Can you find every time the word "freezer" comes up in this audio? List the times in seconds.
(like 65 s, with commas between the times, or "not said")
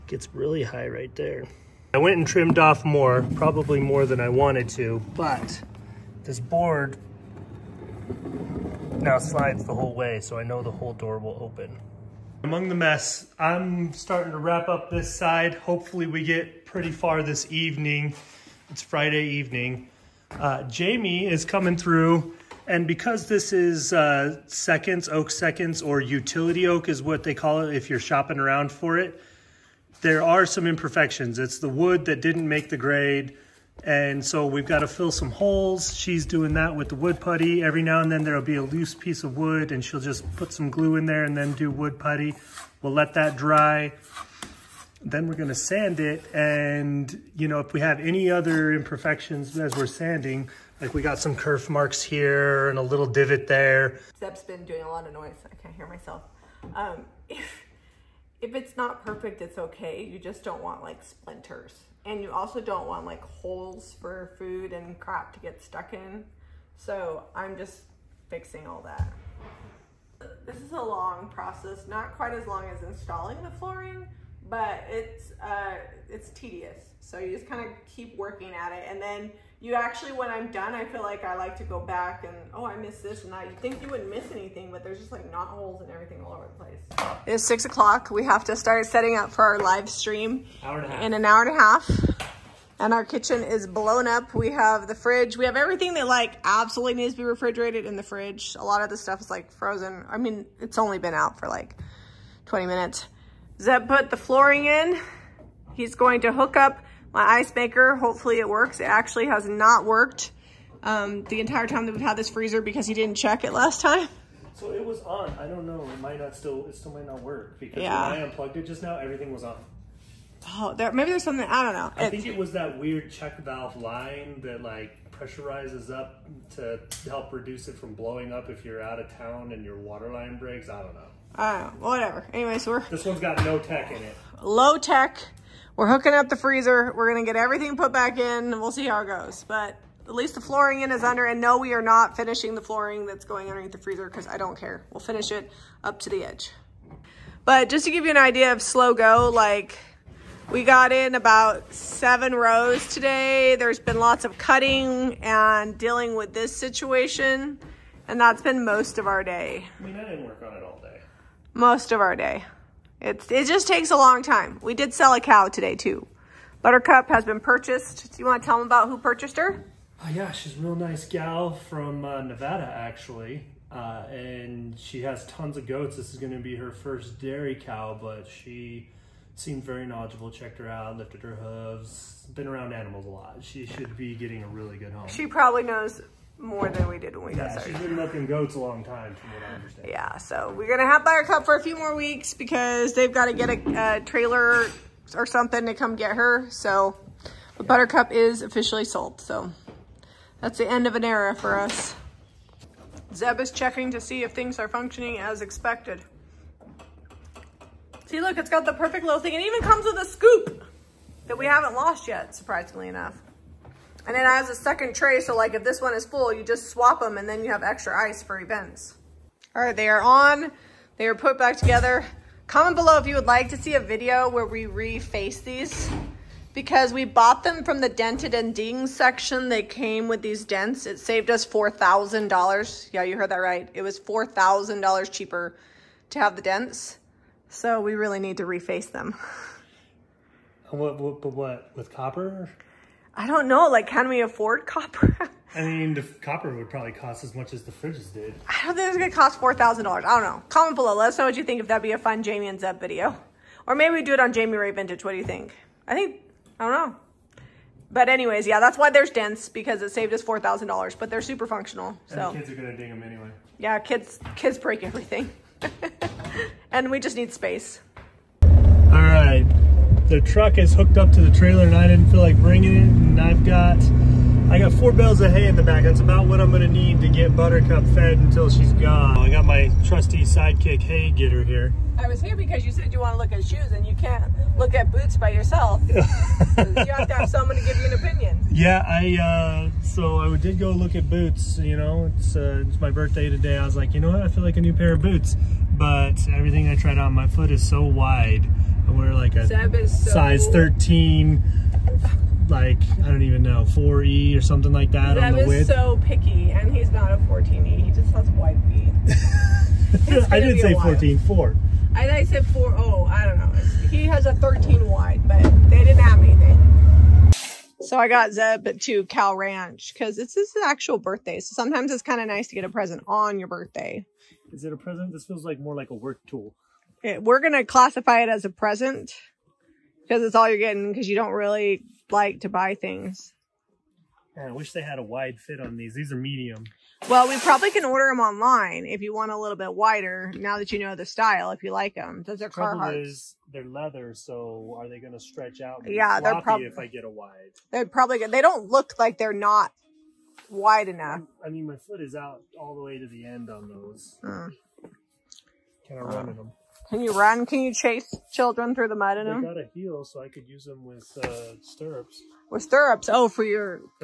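112 s, 136 s, 143 s.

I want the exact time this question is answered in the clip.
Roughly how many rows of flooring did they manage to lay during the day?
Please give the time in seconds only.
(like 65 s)
151 s.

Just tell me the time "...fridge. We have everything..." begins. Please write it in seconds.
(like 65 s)
94 s.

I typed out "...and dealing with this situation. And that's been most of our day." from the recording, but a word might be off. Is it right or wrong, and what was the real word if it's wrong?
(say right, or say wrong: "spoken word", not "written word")
right.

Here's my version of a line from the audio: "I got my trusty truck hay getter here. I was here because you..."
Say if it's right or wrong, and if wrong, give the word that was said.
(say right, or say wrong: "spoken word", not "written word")
wrong: "sidekick", not "truck".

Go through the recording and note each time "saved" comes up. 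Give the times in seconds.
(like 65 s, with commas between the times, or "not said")
230 s, 259 s.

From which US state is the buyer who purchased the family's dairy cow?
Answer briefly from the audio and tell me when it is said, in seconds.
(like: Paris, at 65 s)
Nevada, at 172 s.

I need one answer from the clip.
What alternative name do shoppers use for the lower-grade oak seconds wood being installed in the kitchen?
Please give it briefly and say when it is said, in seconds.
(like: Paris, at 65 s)
utility oak, at 26 s.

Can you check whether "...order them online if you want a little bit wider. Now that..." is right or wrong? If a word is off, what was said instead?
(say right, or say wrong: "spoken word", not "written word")
right.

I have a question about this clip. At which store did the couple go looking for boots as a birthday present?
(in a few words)
Cal Ranch.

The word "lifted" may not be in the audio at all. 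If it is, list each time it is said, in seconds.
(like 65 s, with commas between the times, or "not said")
180 s.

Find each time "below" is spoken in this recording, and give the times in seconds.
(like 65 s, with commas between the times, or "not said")
222 s, 250 s.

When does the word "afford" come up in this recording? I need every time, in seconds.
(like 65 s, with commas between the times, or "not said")
244 s.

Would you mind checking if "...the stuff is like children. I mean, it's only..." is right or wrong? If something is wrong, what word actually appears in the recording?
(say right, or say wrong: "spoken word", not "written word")
wrong: "frozen", not "children".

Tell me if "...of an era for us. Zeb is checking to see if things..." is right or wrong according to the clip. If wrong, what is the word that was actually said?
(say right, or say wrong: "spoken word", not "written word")
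right.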